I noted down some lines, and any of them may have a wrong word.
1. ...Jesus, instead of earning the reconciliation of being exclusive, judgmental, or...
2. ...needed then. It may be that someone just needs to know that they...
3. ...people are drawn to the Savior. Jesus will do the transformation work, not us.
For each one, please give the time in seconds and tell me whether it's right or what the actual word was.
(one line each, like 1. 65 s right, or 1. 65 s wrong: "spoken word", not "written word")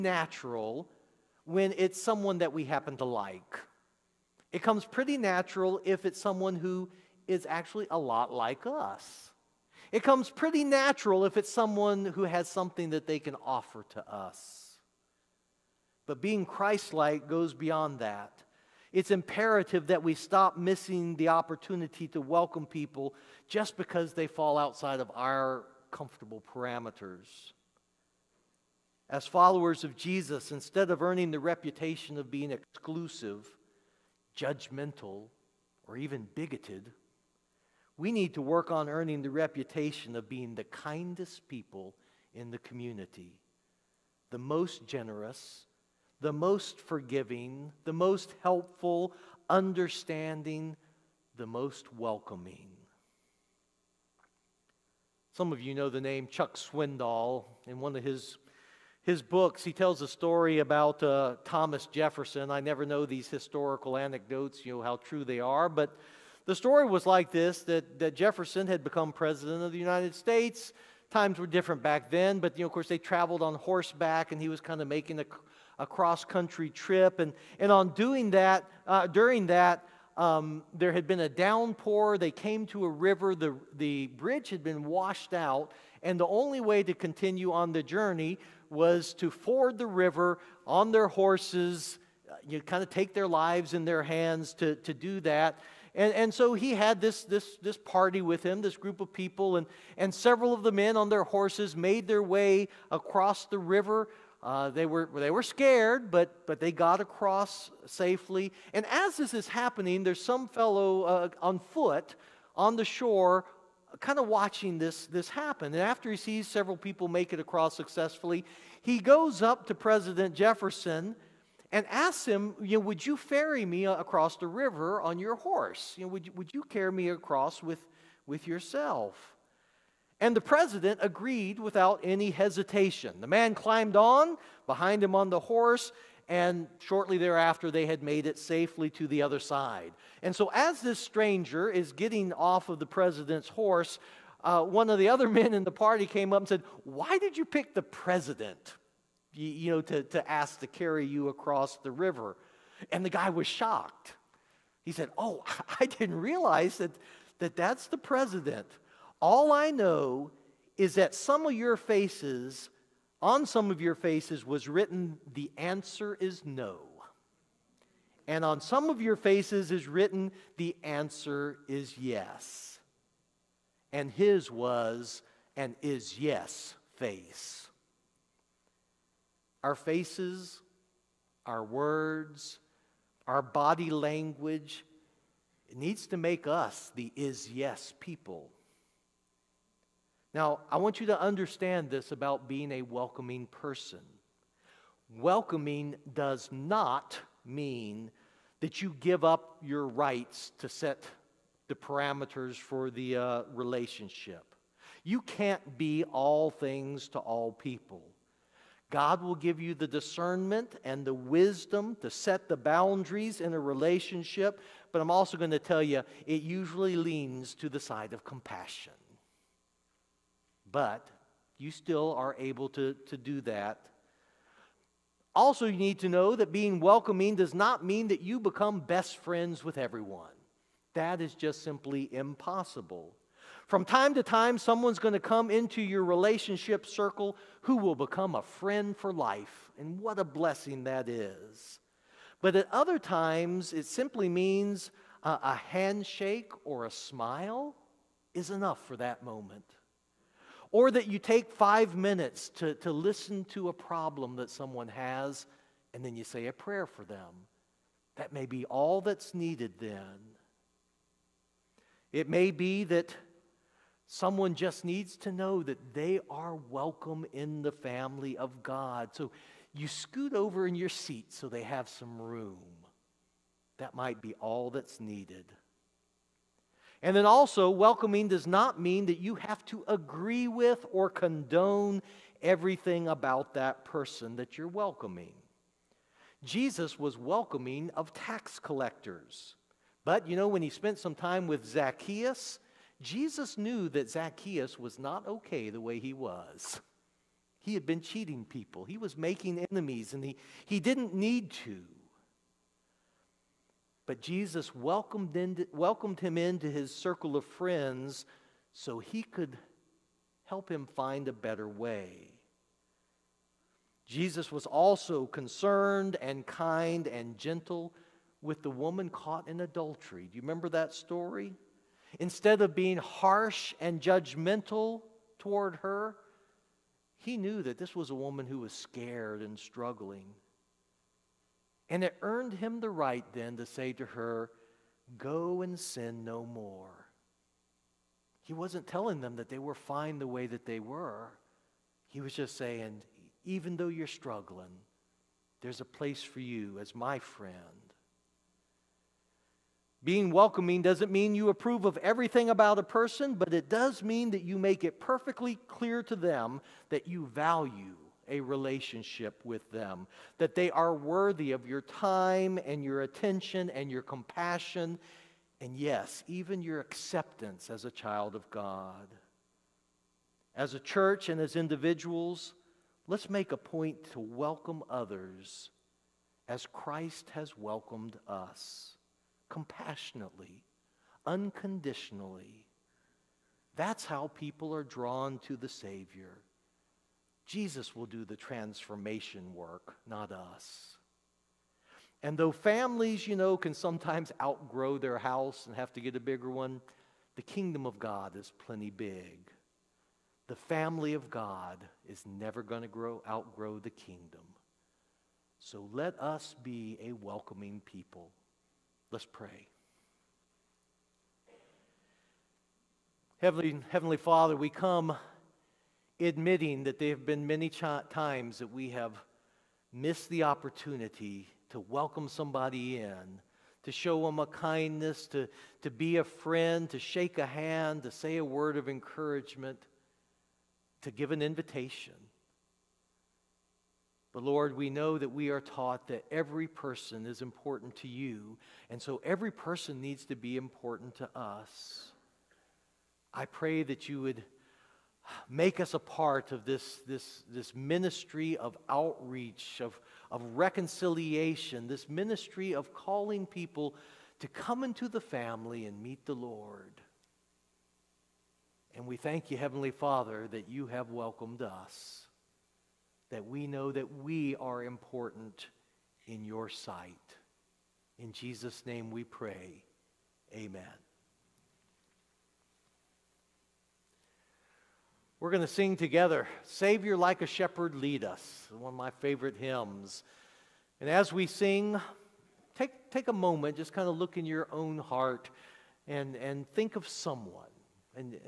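1. 29 s wrong: "reputation", not "reconciliation"
2. 259 s right
3. 384 s right.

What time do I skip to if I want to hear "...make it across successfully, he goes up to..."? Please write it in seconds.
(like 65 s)
117 s.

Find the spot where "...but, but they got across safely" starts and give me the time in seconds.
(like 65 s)
106 s.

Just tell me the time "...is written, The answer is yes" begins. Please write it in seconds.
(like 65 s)
169 s.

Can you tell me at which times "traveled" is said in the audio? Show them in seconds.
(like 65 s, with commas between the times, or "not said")
72 s.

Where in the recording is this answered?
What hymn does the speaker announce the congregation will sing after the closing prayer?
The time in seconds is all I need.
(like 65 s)
476 s.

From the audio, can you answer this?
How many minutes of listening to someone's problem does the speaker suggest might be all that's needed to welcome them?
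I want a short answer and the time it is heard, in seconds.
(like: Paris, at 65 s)
5, at 251 s.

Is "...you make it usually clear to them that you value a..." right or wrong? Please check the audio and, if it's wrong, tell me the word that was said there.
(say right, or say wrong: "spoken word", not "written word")
wrong: "perfectly", not "usually".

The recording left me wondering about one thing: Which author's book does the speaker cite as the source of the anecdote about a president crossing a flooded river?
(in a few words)
Chuck Swindoll.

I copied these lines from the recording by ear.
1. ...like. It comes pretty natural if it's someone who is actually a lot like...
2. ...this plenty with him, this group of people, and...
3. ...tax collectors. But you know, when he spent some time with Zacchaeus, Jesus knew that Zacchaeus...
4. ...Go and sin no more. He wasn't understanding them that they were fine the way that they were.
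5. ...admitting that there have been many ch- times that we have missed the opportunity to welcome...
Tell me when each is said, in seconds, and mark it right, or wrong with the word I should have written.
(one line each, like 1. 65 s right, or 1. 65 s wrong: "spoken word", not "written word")
1. 3 s right
2. 97 s wrong: "party", not "plenty"
3. 288 s right
4. 335 s wrong: "telling", not "understanding"
5. 416 s right.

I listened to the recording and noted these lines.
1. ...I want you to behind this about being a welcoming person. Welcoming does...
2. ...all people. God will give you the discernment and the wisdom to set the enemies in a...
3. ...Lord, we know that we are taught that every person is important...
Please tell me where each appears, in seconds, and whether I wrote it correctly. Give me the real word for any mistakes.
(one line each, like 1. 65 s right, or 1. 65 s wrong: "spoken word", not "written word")
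1. 190 s wrong: "understand", not "behind"
2. 207 s wrong: "boundaries", not "enemies"
3. 434 s right.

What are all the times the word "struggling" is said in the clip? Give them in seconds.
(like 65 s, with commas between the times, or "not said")
329 s, 344 s.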